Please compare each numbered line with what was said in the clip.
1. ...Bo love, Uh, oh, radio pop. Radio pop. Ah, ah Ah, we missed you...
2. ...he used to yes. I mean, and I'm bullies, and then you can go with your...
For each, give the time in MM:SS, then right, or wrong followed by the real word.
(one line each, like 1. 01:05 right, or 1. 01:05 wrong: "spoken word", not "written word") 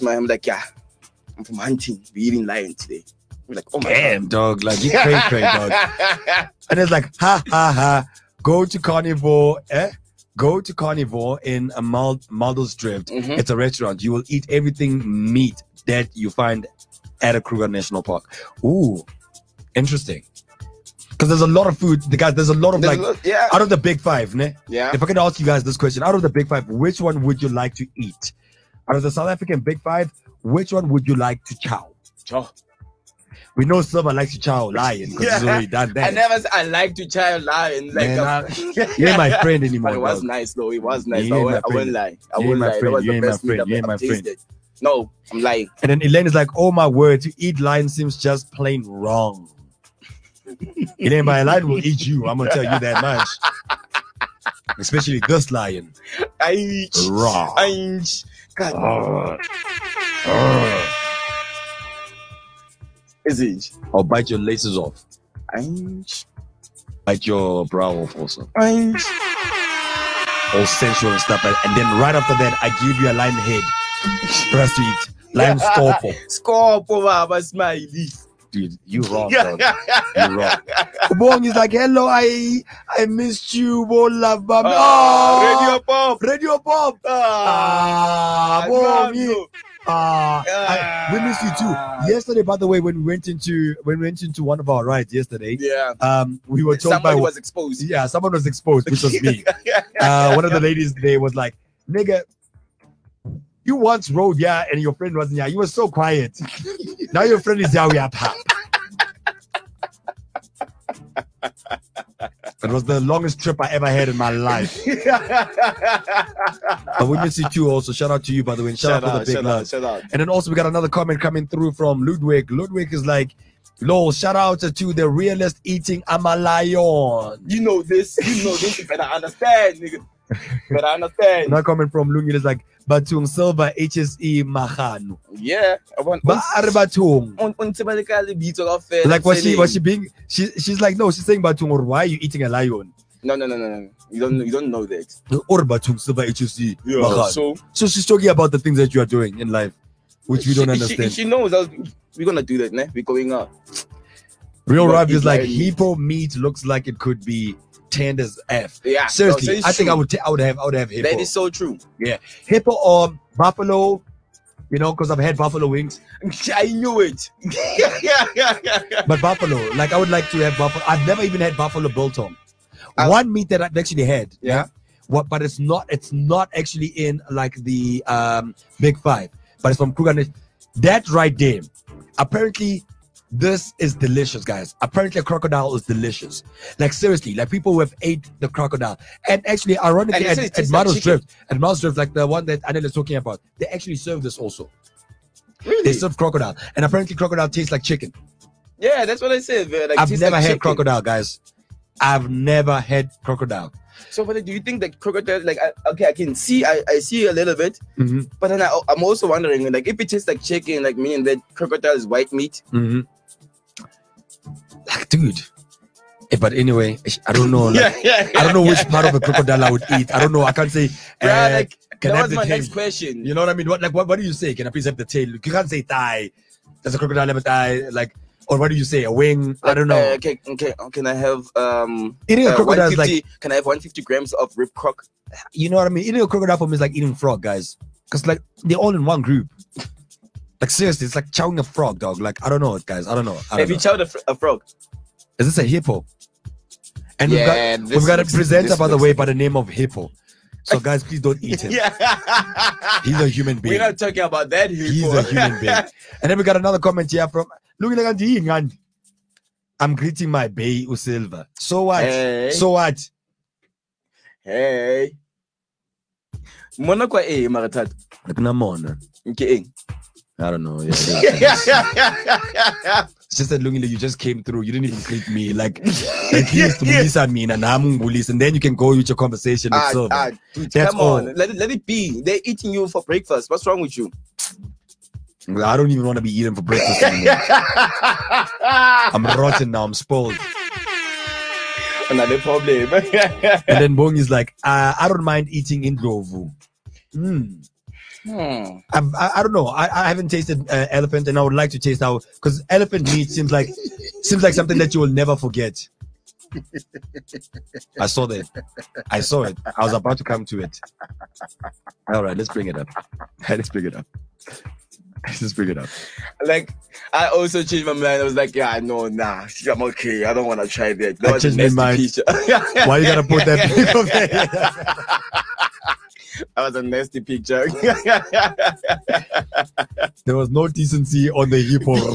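1. 01:23 right
2. 04:36 right.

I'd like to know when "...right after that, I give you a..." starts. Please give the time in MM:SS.
01:11.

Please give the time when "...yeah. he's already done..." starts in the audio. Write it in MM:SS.
00:35.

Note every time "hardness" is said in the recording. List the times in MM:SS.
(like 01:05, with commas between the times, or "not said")
not said.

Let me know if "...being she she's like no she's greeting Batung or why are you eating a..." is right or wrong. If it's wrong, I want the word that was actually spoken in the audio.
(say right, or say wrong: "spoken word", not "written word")
wrong: "saying", not "greeting".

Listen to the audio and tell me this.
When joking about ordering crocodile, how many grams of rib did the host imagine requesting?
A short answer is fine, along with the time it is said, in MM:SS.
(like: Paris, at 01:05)
150, at 03:53.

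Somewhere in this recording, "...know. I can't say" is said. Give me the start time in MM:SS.
03:40.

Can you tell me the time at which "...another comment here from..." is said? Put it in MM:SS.
04:16.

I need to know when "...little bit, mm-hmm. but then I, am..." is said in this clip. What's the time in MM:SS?
03:27.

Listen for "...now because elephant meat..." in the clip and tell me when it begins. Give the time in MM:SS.
05:02.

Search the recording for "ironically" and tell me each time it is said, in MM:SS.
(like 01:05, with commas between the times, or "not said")
03:09.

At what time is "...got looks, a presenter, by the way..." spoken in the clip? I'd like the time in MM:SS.
04:08.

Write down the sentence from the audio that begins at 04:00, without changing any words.
Like seriously, it's like chowing a frog, dog.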